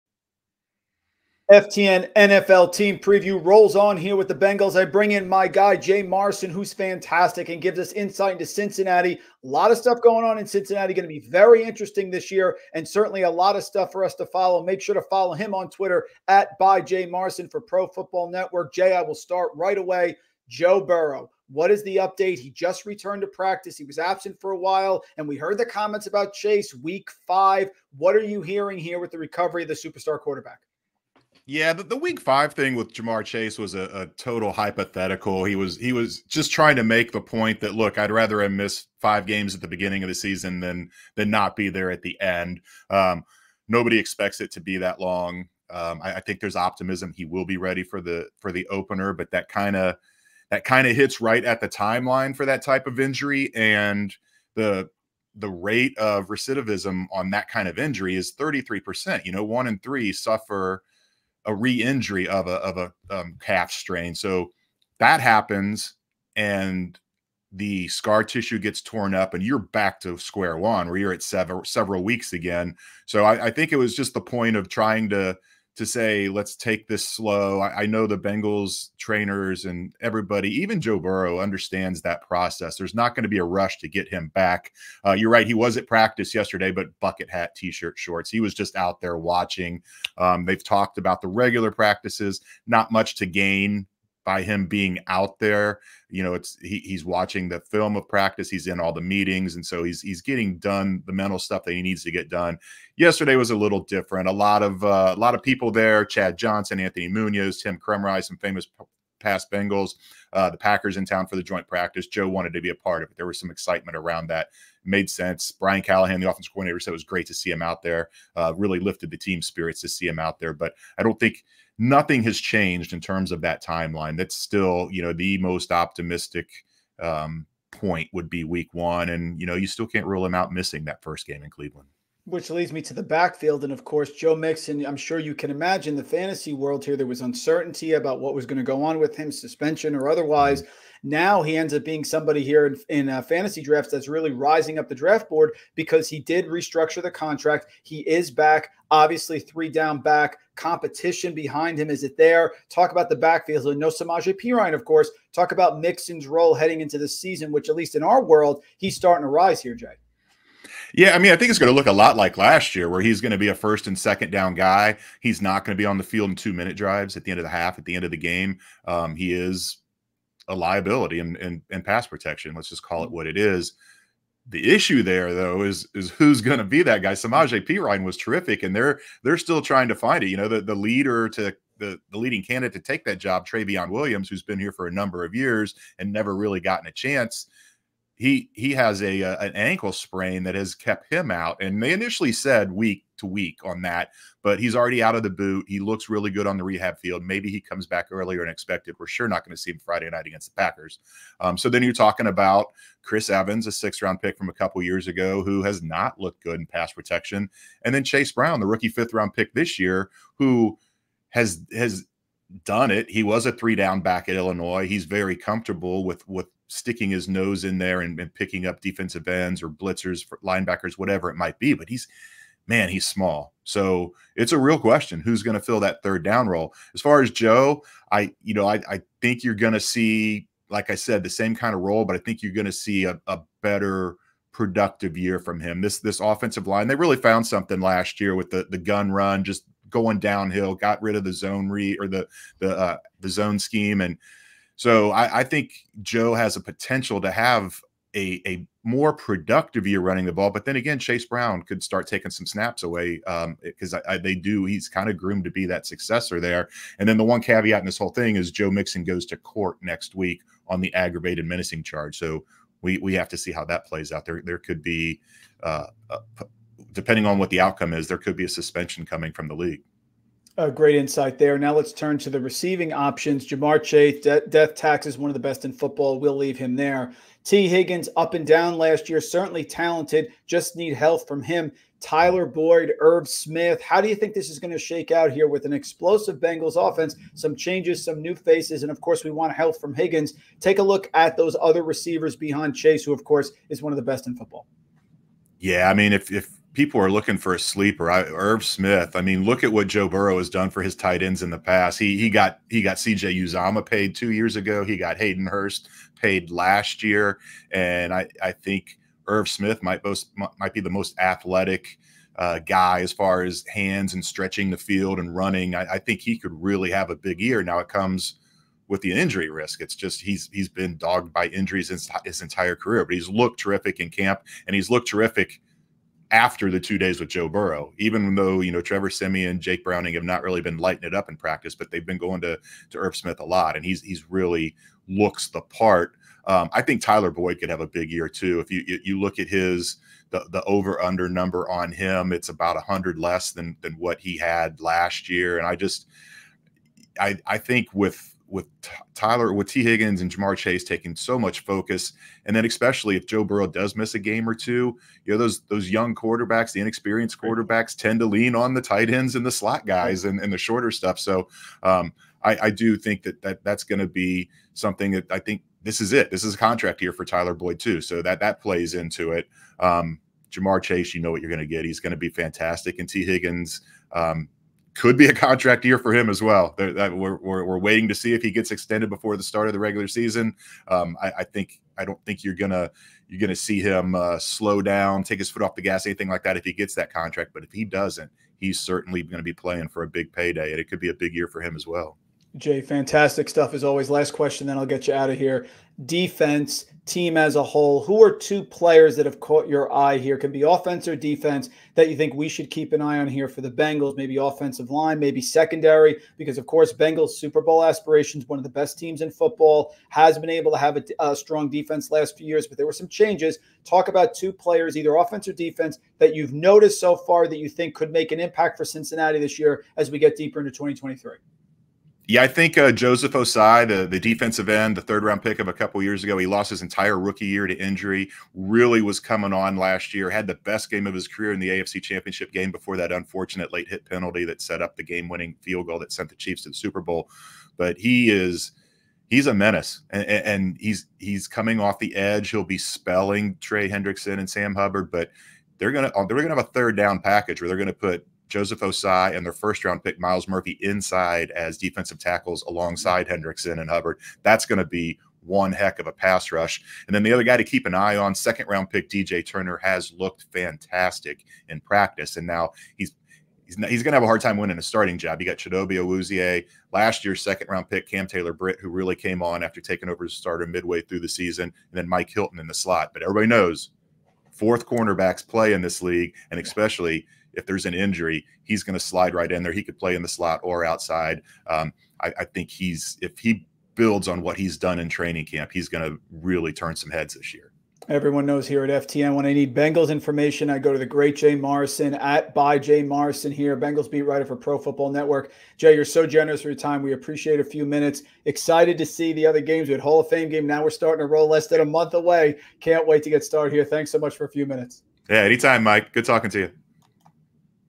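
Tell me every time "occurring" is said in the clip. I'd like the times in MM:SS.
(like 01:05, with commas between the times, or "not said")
not said.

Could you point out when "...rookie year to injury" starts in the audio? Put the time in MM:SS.
07:07.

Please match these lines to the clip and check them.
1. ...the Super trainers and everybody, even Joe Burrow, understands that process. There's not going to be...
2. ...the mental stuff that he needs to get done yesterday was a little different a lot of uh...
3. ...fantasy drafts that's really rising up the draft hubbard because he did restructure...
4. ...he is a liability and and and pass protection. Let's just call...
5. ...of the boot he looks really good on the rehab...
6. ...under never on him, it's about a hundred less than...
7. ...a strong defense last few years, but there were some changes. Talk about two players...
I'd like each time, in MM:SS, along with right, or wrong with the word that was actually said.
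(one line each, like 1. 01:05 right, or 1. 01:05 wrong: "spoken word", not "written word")
1. 01:18 wrong: "Bengals", not "Super"
2. 01:41 right
3. 02:23 wrong: "board", not "hubbard"
4. 02:49 right
5. 03:15 right
6. 05:41 wrong: "number", not "never"
7. 06:51 right.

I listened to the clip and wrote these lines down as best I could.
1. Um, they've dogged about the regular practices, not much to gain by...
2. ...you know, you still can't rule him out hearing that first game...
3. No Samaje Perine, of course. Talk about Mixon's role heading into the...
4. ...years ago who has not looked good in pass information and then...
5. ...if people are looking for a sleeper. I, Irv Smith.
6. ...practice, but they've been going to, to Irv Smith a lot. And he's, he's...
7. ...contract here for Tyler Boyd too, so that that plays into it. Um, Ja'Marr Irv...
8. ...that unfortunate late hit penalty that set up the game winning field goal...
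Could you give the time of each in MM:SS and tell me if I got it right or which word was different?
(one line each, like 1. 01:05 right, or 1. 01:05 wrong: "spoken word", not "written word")
1. 01:30 wrong: "talked", not "dogged"
2. 02:09 wrong: "missing", not "hearing"
3. 02:33 right
4. 03:24 wrong: "protection", not "information"
5. 04:56 right
6. 05:31 right
7. 06:06 wrong: "Chase", not "Irv"
8. 07:12 right.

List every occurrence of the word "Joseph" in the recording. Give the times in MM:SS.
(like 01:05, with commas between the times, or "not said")
07:02, 07:28.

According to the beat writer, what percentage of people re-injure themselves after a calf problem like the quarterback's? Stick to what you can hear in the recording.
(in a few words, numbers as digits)
33%.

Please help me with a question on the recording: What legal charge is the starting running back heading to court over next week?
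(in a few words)
Aggravated menacing.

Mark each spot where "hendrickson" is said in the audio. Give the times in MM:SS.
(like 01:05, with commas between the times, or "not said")
07:23, 07:33.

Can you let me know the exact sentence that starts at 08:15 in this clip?
Jay, you're so generous for your time.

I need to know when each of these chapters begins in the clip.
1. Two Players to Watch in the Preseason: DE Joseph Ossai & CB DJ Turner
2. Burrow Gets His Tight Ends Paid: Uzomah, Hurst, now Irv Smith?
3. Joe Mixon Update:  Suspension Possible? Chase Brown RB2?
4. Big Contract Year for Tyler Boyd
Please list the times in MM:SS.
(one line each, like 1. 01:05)
1. 06:32
2. 04:29
3. 02:12
4. 05:39.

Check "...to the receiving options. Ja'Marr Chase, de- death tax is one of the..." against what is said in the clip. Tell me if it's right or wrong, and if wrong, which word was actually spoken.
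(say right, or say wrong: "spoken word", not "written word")
right.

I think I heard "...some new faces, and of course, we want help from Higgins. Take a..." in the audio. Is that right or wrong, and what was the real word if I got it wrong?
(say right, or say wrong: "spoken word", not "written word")
right.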